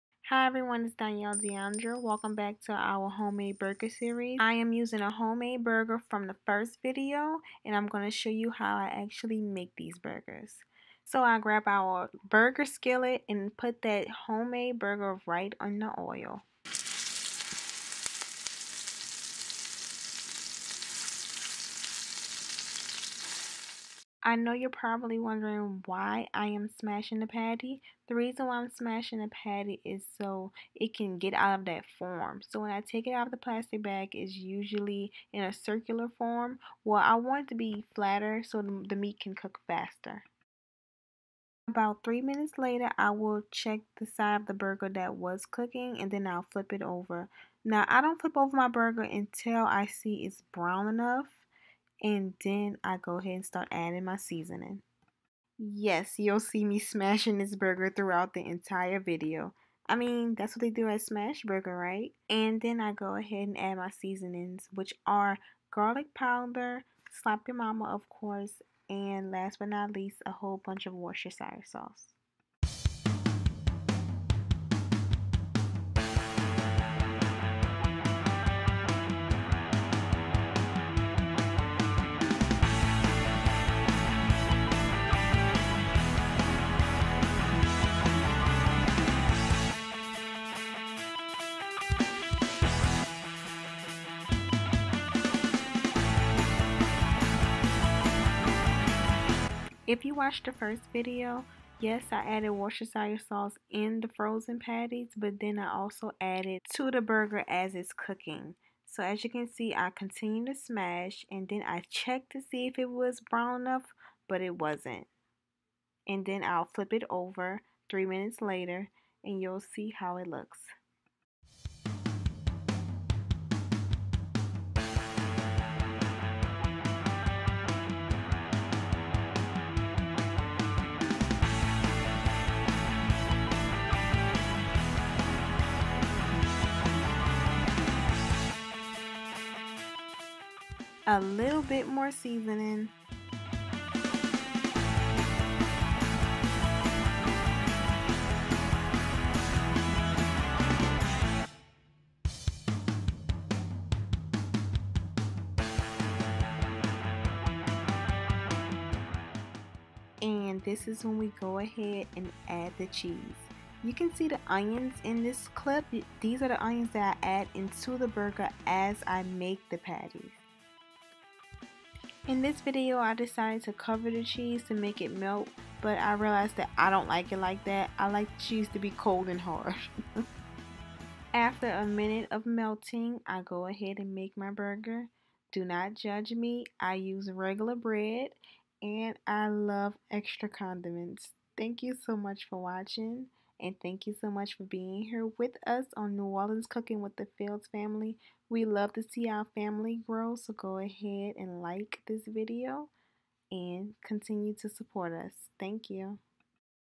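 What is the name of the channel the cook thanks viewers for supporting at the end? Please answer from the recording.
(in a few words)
New Orleans Cooking with the Fields family.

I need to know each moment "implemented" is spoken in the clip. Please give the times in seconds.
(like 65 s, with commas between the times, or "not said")
not said.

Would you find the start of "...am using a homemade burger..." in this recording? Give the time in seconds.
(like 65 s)
4 s.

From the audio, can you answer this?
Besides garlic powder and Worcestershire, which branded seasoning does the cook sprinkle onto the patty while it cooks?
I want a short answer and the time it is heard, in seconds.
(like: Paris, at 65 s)
Slap Ya Mama, at 67 s.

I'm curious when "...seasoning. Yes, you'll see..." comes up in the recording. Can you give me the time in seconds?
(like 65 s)
54 s.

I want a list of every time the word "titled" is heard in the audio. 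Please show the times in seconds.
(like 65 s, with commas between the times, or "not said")
not said.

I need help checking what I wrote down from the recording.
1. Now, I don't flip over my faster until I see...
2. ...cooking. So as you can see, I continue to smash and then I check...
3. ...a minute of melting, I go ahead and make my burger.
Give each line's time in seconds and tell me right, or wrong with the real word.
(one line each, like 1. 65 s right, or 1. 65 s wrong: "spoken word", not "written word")
1. 47 s wrong: "burger", not "faster"
2. 107 s right
3. 181 s right.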